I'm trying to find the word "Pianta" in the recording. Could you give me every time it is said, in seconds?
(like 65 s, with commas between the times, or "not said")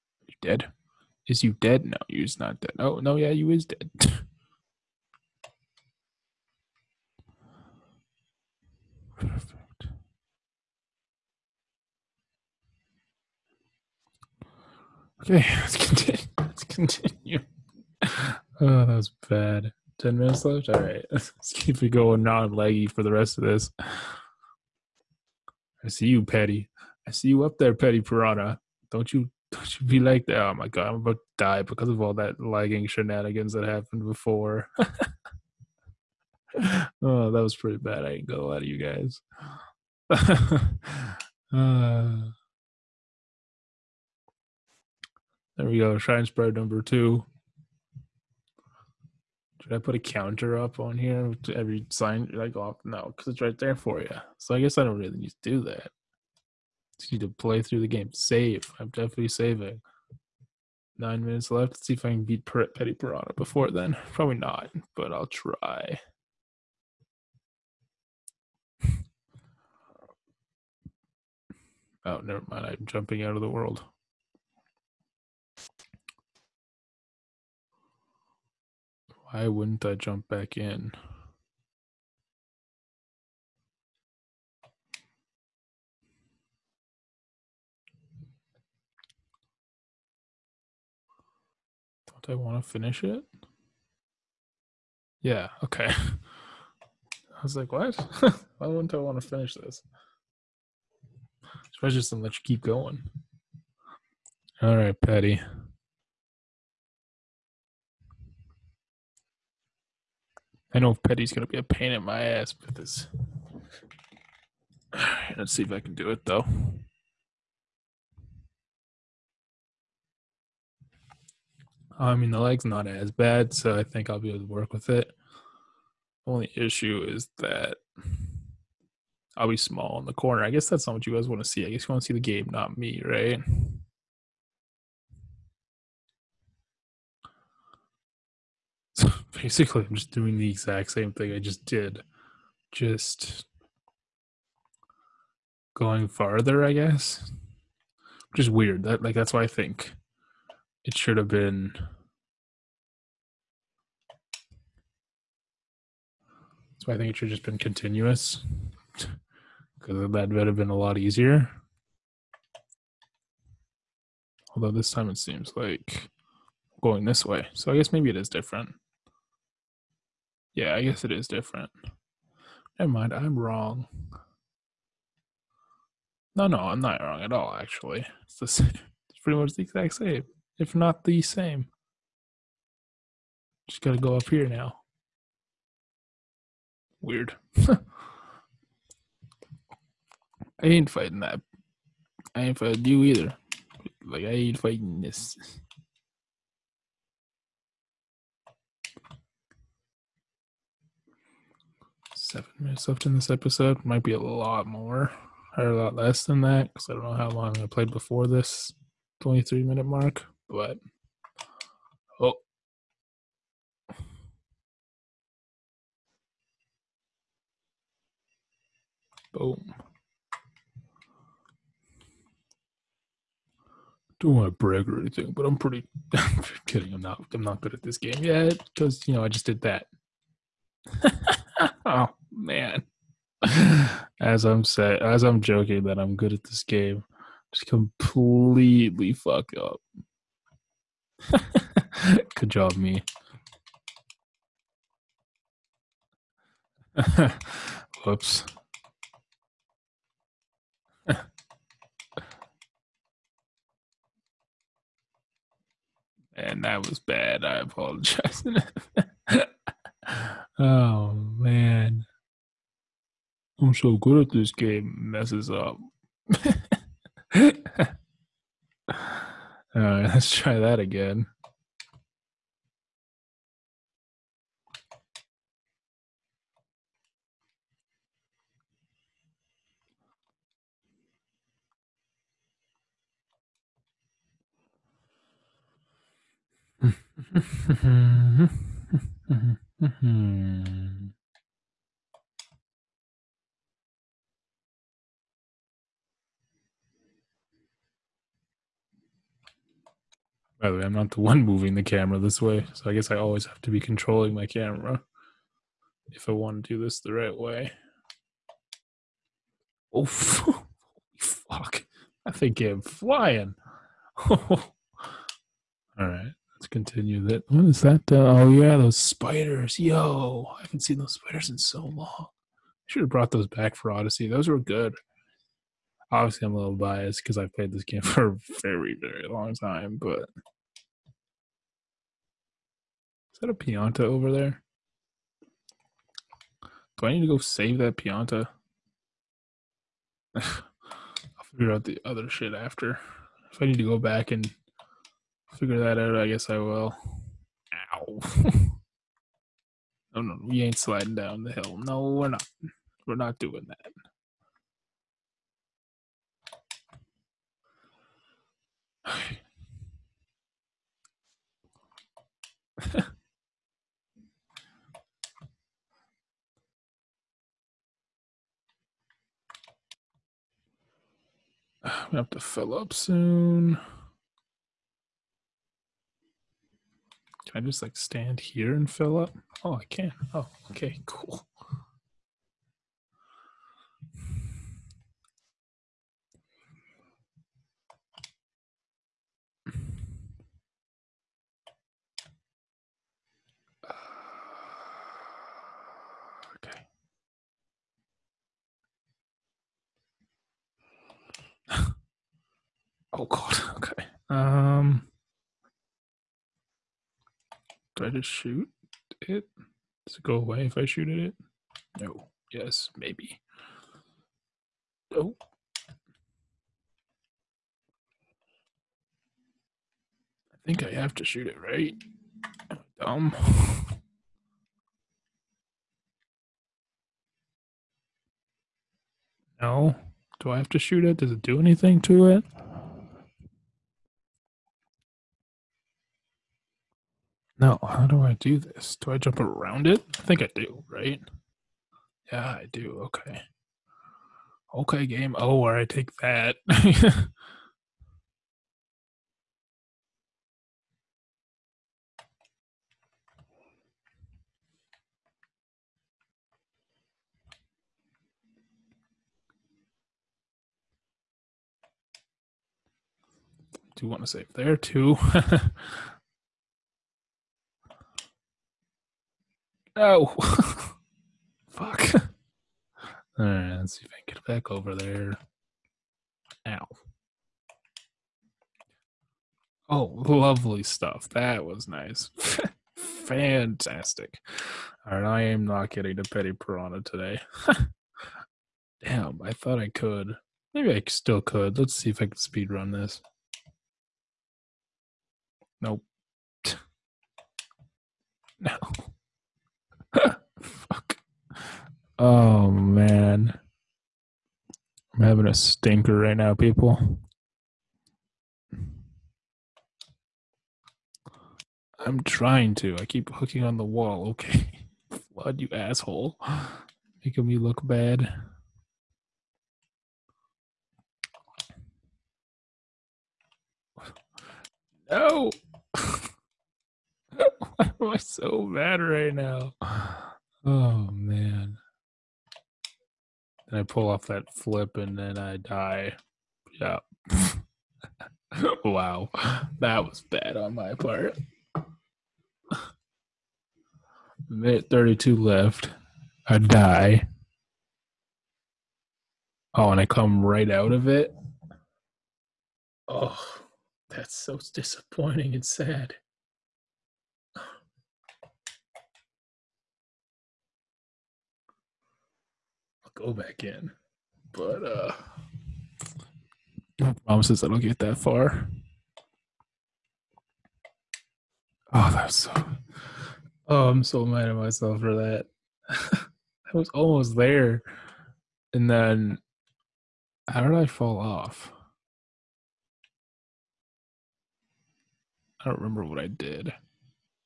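333 s, 337 s.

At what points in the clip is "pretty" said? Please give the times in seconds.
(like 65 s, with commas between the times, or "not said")
37 s, 179 s, 225 s.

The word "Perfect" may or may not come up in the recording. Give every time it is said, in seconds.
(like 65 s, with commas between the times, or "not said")
9 s.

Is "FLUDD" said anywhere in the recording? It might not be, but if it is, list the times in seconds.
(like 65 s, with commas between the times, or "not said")
515 s.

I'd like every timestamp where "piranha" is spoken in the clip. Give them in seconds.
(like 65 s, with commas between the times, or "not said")
28 s, 62 s, 486 s.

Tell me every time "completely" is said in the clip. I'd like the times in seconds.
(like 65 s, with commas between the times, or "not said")
237 s.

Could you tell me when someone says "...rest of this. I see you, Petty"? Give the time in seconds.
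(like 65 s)
23 s.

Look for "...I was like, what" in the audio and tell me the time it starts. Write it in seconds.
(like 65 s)
95 s.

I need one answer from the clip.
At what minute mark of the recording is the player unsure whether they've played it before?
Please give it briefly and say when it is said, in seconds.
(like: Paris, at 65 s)
23, at 209 s.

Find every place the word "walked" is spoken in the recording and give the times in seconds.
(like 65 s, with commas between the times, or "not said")
not said.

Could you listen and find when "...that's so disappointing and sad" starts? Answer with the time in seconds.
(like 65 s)
554 s.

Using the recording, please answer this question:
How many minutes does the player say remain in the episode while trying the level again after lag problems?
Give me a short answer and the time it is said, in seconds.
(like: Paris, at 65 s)
7, at 202 s.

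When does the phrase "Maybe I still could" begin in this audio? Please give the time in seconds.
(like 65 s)
490 s.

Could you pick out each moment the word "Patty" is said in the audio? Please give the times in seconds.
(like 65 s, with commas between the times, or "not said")
104 s.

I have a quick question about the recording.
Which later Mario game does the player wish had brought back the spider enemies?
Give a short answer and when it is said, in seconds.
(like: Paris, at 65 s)
Odyssey, at 323 s.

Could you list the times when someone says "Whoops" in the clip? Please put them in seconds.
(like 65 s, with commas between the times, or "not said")
248 s.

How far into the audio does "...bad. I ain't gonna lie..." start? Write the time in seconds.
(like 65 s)
37 s.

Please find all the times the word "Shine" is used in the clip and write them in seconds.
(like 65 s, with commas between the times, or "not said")
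45 s.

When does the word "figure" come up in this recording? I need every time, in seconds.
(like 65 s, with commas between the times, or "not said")
341 s, 345 s.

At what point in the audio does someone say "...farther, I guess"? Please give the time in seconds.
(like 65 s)
146 s.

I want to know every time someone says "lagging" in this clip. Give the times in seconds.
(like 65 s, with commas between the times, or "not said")
32 s.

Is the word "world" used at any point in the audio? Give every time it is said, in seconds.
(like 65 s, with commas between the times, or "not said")
73 s.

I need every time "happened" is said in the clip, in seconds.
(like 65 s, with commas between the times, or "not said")
33 s.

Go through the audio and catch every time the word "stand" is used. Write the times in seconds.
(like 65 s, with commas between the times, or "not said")
377 s.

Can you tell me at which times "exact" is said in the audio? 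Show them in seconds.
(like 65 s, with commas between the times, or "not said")
140 s, 179 s.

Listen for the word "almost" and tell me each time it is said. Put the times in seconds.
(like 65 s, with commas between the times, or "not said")
576 s.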